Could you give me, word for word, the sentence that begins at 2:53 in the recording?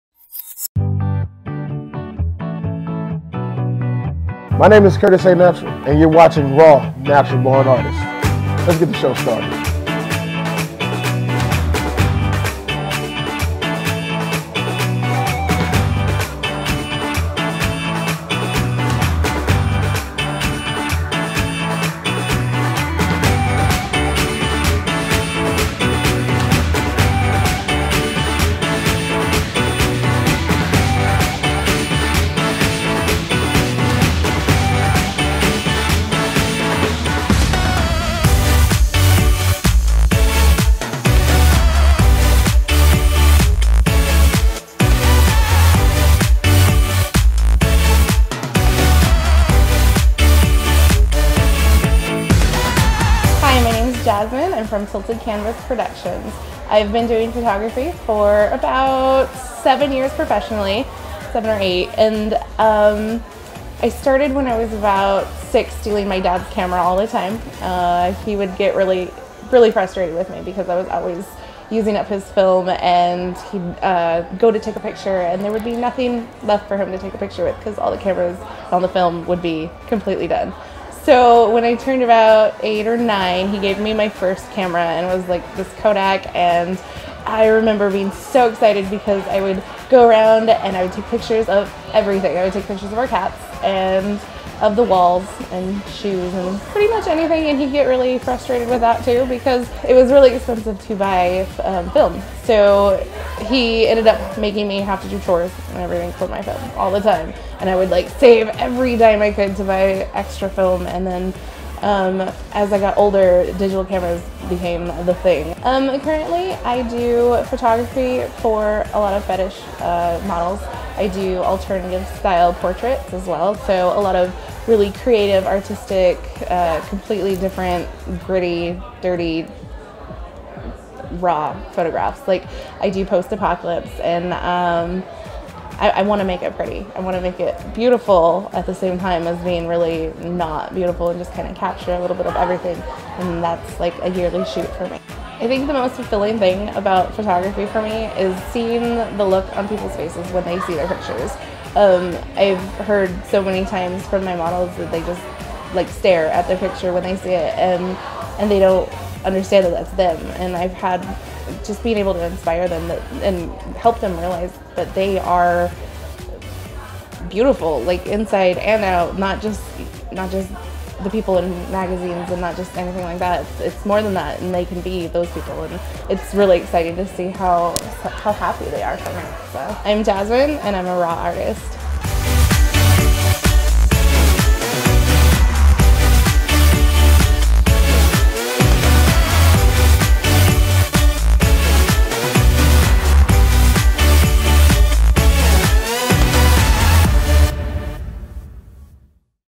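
It's, it's more than that, and they can be those people.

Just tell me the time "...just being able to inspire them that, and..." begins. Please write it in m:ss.
2:41.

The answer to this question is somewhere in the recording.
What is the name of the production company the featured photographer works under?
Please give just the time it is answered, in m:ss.
0:54.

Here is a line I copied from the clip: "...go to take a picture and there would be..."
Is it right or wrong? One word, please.
right.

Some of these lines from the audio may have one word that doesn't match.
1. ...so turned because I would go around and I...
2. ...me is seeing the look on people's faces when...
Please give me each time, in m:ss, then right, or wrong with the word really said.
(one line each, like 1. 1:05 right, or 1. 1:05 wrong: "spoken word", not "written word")
1. 1:28 wrong: "excited", not "turned"
2. 2:27 right.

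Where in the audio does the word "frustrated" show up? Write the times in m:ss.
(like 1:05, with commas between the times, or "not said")
1:09, 1:38.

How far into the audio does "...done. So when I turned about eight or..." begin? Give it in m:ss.
1:20.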